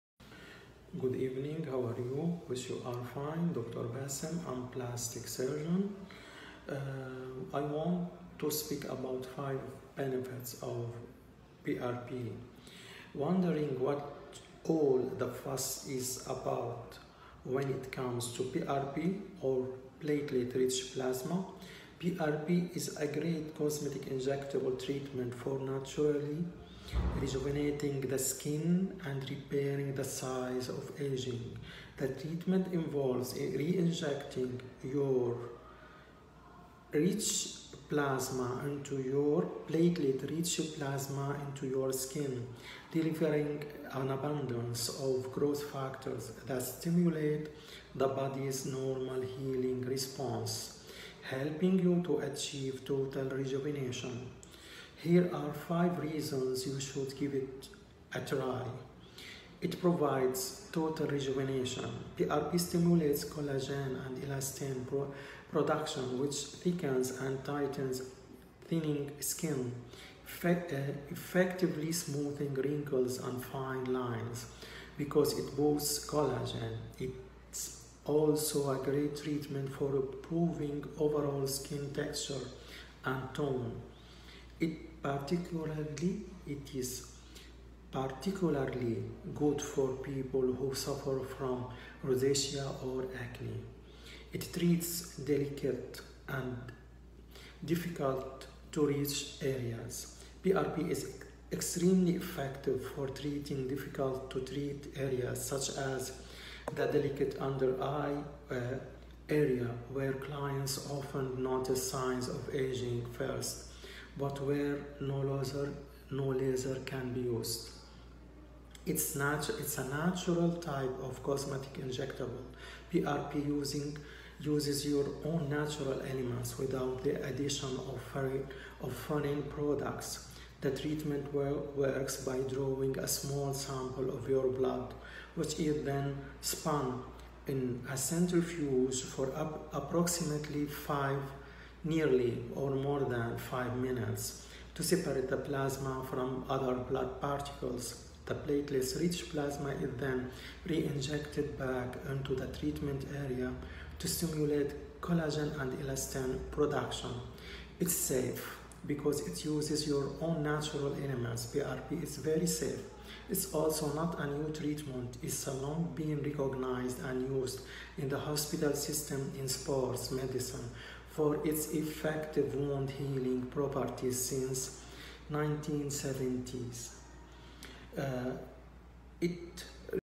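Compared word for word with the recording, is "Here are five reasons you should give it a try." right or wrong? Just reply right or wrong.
right.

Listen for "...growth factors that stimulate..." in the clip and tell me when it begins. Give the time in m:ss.
0:45.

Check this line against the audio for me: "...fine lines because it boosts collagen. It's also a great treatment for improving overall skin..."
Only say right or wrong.
right.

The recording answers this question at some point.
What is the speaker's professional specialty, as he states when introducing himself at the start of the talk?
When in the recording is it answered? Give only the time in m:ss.
0:04.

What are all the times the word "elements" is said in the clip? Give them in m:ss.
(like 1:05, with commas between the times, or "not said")
2:06, 2:41.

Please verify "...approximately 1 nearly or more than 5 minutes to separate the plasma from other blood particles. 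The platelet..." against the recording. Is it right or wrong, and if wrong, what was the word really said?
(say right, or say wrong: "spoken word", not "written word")
wrong: "5", not "1".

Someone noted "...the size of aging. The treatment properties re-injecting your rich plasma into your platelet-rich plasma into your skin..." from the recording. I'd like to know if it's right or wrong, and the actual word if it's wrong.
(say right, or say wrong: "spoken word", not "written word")
wrong: "involves", not "properties".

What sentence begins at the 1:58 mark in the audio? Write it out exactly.
It's, natu it's a natural type of cosmetic injectable.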